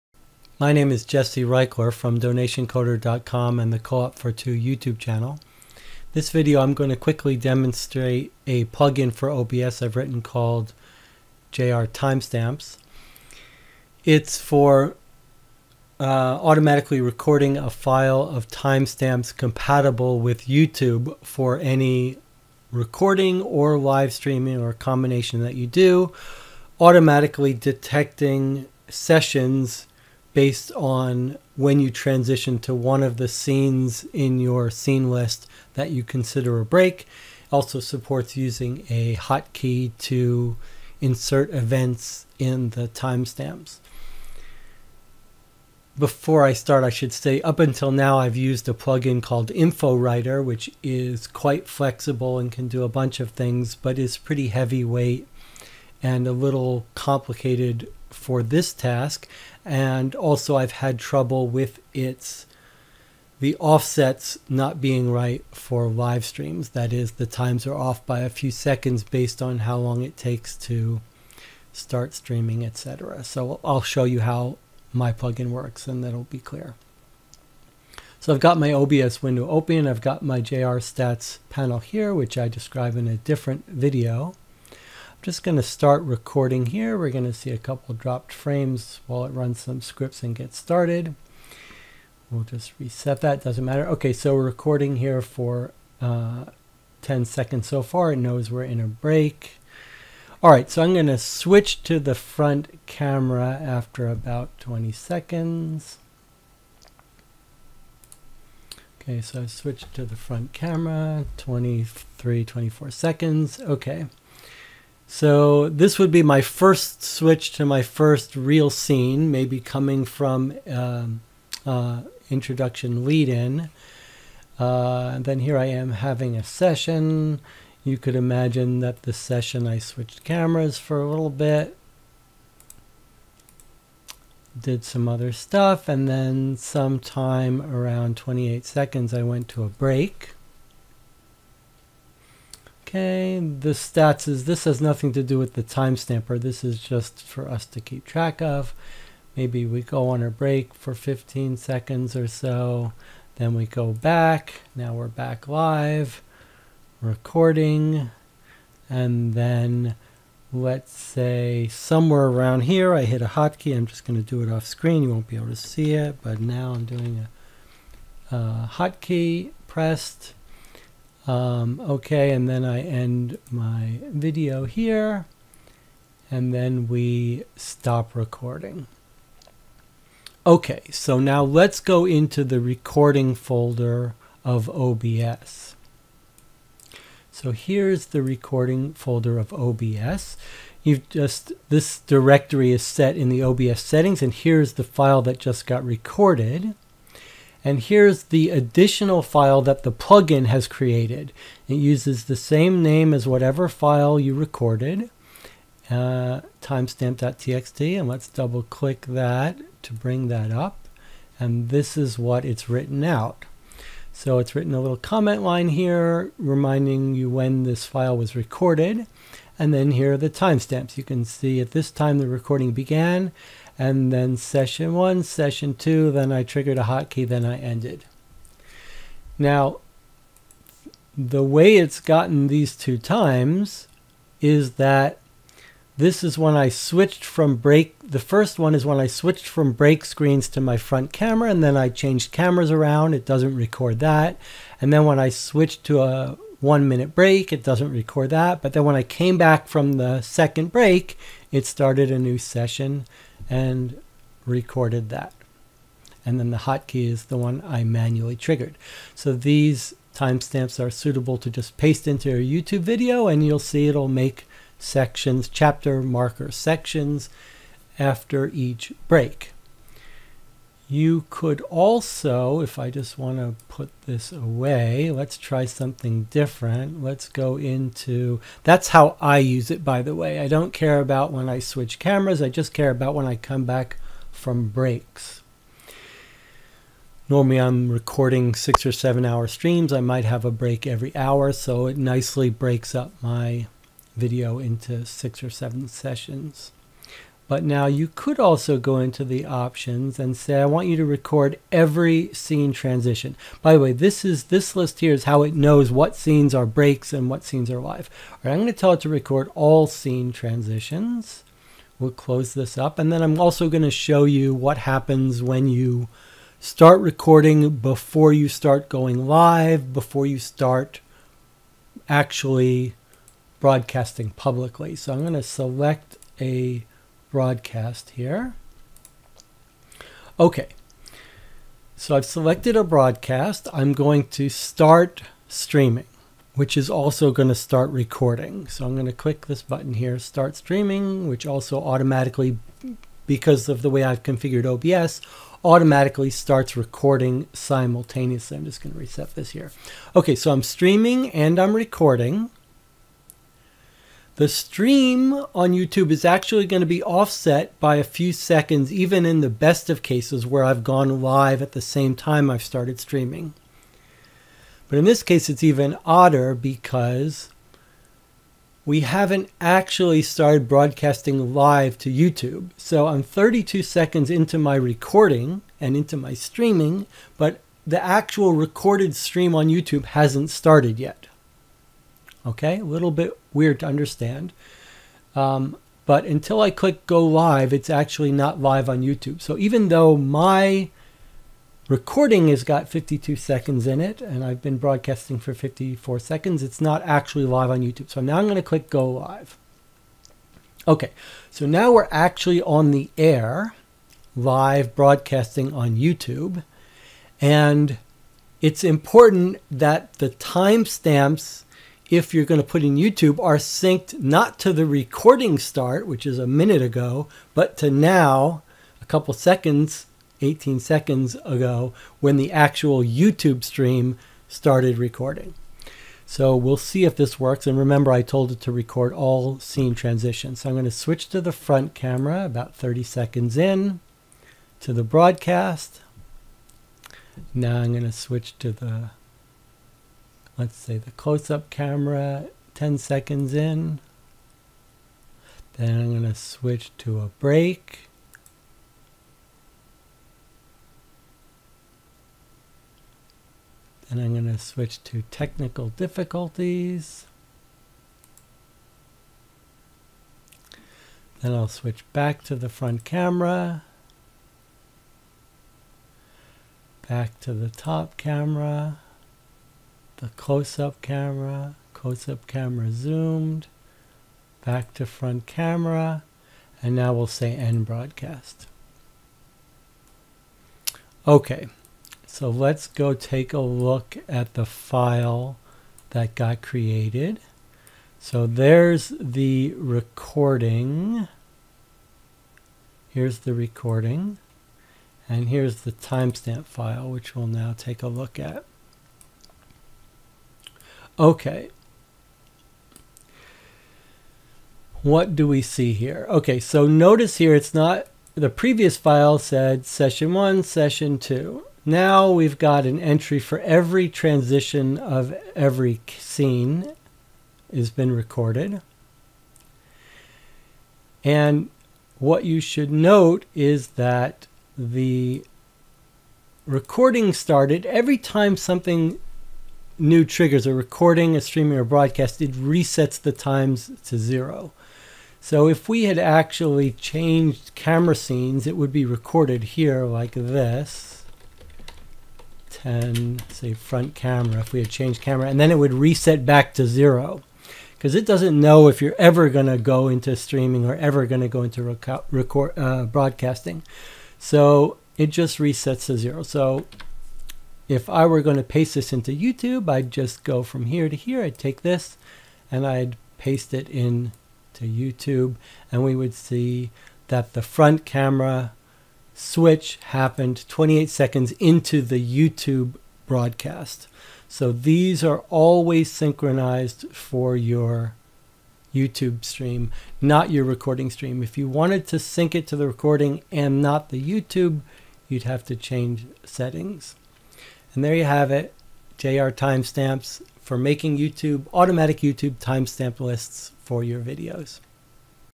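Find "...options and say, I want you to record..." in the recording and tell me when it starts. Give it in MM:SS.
04:59.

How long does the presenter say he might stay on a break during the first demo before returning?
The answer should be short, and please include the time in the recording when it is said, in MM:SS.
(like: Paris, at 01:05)
15 seconds, at 02:30.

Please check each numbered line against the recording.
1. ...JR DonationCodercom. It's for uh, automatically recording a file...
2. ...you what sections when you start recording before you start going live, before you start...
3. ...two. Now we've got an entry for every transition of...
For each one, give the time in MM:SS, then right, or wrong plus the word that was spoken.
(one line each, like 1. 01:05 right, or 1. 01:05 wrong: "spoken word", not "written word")
1. 00:11 wrong: "Timestamps", not "DonationCodercom"
2. 05:14 wrong: "happens", not "sections"
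3. 08:31 right.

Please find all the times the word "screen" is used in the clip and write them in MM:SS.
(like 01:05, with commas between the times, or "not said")
02:44, 04:00.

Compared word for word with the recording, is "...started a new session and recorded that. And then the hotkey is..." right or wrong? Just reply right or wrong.
right.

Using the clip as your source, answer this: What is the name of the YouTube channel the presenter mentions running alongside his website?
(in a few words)
Co-op for Two.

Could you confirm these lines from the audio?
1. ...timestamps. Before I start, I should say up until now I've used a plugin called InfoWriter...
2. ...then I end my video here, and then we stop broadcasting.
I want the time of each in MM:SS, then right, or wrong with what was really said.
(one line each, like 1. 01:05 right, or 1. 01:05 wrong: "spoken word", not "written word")
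1. 00:42 right
2. 02:52 wrong: "recording", not "broadcasting".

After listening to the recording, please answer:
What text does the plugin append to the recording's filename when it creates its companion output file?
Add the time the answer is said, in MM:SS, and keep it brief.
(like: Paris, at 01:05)
timestamp.txt, at 03:26.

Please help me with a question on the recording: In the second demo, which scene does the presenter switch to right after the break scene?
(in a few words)
technical difficulties.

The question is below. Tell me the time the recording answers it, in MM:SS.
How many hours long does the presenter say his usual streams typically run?
04:48.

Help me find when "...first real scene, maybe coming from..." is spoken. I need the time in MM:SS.
01:57.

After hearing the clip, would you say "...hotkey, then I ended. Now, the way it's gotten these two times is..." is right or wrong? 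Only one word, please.
right.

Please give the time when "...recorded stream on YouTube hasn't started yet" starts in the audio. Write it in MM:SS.
06:18.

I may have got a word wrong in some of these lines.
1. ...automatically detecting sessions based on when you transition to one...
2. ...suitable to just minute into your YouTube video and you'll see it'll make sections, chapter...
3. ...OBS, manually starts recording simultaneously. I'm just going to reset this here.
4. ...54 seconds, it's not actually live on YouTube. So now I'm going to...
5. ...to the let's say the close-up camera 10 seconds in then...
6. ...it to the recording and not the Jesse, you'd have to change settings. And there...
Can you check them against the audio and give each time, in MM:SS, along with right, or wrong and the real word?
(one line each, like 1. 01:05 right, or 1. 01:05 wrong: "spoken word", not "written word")
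1. 00:26 right
2. 04:20 wrong: "paste", not "minute"
3. 05:44 wrong: "automatically", not "manually"
4. 06:35 right
5. 07:18 right
6. 09:42 wrong: "YouTube", not "Jesse".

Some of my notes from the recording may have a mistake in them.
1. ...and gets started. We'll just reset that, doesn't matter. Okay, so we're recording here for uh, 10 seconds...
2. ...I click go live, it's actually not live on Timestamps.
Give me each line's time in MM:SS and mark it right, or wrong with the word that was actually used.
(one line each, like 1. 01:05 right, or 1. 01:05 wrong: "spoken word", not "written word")
1. 01:30 right
2. 06:26 wrong: "YouTube", not "Timestamps".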